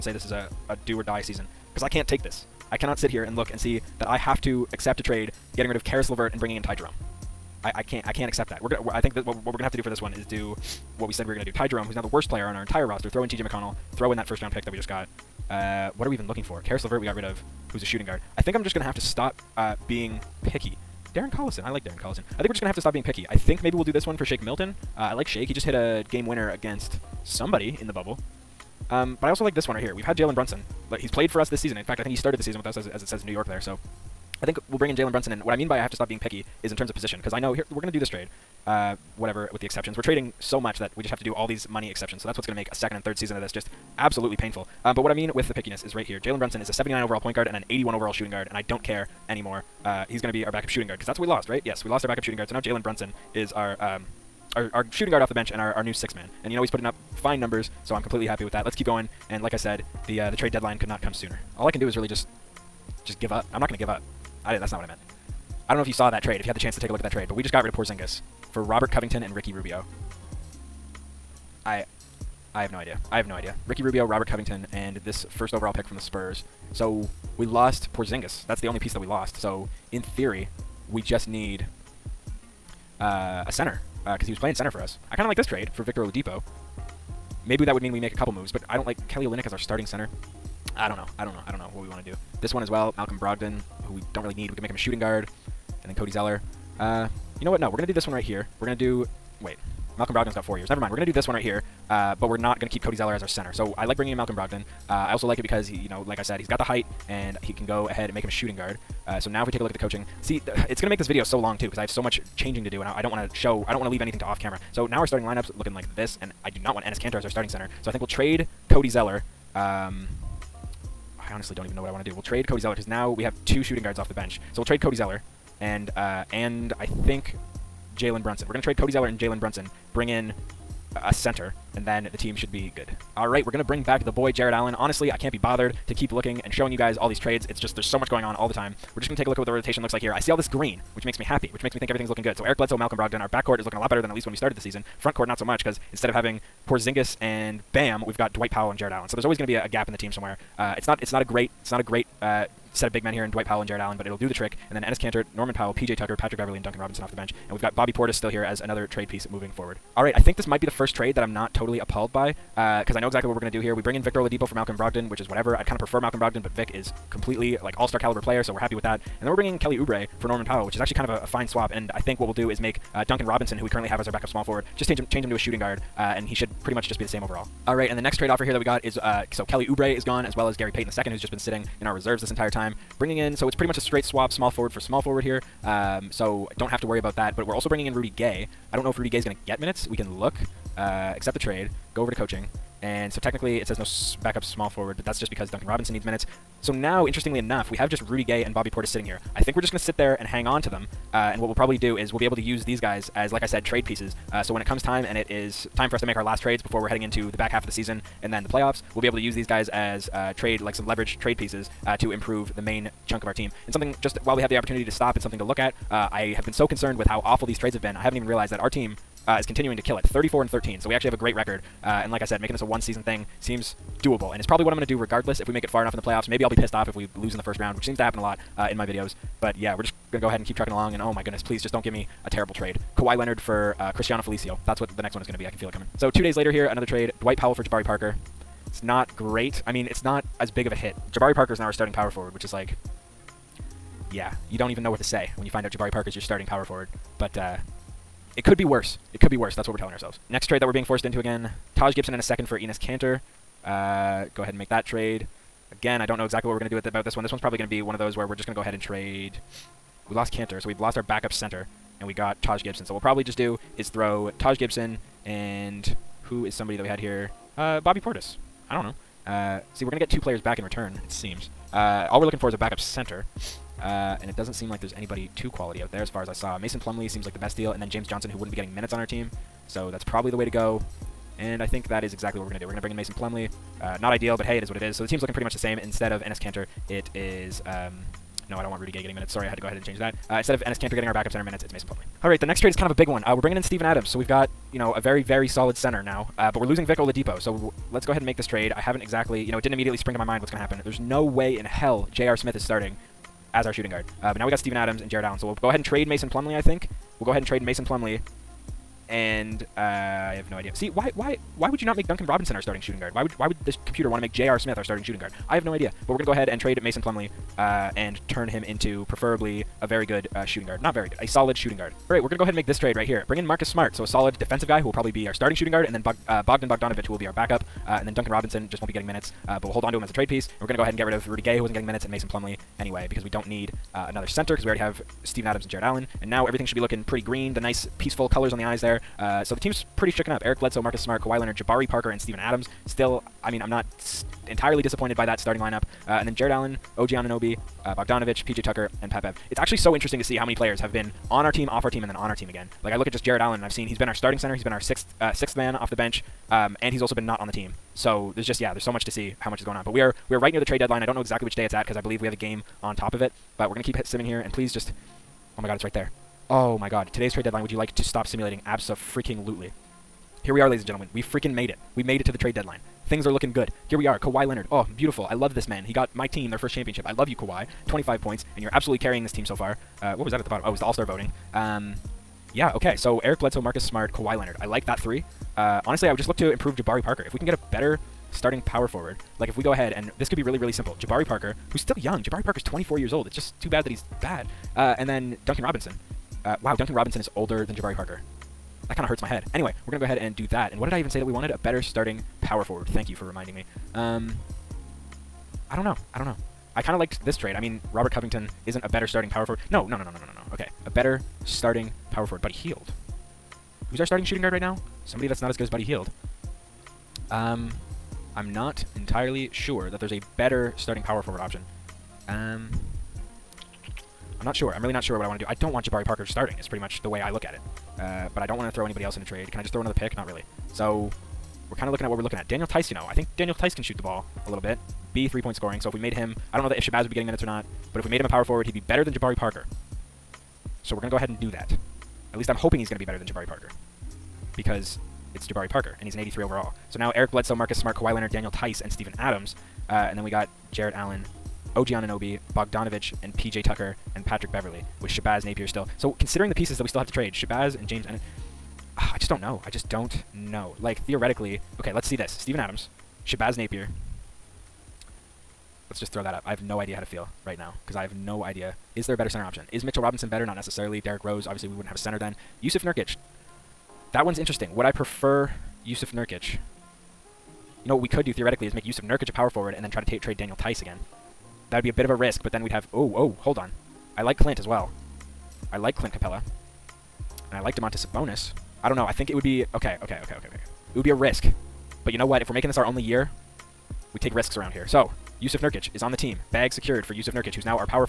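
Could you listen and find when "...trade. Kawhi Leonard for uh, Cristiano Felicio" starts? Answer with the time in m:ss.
3:52.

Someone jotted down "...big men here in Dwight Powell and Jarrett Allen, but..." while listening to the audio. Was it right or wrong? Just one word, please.
right.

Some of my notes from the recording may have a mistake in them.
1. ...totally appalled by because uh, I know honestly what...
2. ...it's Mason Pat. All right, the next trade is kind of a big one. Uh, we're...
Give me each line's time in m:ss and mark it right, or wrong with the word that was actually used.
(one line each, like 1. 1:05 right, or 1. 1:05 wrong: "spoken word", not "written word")
1. 2:41 wrong: "exactly", not "honestly"
2. 4:51 wrong: "Plumlee", not "Pat".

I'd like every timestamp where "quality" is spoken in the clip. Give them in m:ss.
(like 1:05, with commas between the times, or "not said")
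4:35.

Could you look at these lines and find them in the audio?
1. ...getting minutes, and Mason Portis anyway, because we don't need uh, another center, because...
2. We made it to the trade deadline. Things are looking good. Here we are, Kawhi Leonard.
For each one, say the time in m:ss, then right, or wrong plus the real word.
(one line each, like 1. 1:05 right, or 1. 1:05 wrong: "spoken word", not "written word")
1. 5:31 wrong: "Plumlee", not "Portis"
2. 6:11 right.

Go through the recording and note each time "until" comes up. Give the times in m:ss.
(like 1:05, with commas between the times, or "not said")
not said.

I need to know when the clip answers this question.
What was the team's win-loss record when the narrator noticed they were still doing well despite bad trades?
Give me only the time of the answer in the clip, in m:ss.
3:40.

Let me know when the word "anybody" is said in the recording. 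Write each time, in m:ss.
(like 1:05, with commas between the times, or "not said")
4:34, 7:08.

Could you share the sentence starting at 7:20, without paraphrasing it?
So we're going to go ahead and do that.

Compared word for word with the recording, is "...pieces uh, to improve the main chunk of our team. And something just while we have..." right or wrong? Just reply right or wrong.
right.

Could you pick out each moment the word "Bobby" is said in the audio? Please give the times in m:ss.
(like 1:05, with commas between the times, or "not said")
2:37, 3:18, 4:27.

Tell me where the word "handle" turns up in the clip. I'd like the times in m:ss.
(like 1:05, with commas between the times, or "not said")
not said.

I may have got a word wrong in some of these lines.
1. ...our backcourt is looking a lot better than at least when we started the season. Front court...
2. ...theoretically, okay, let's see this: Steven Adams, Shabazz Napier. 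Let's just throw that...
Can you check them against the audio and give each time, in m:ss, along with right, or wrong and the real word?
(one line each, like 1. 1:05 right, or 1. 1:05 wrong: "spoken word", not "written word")
1. 2:23 right
2. 7:41 right.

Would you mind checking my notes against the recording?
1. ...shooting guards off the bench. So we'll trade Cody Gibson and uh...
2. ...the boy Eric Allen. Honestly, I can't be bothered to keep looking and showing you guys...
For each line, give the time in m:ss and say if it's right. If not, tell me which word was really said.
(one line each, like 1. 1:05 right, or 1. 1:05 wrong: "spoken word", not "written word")
1. 2:03 wrong: "Zeller", not "Gibson"
2. 2:14 wrong: "Jarrett", not "Eric".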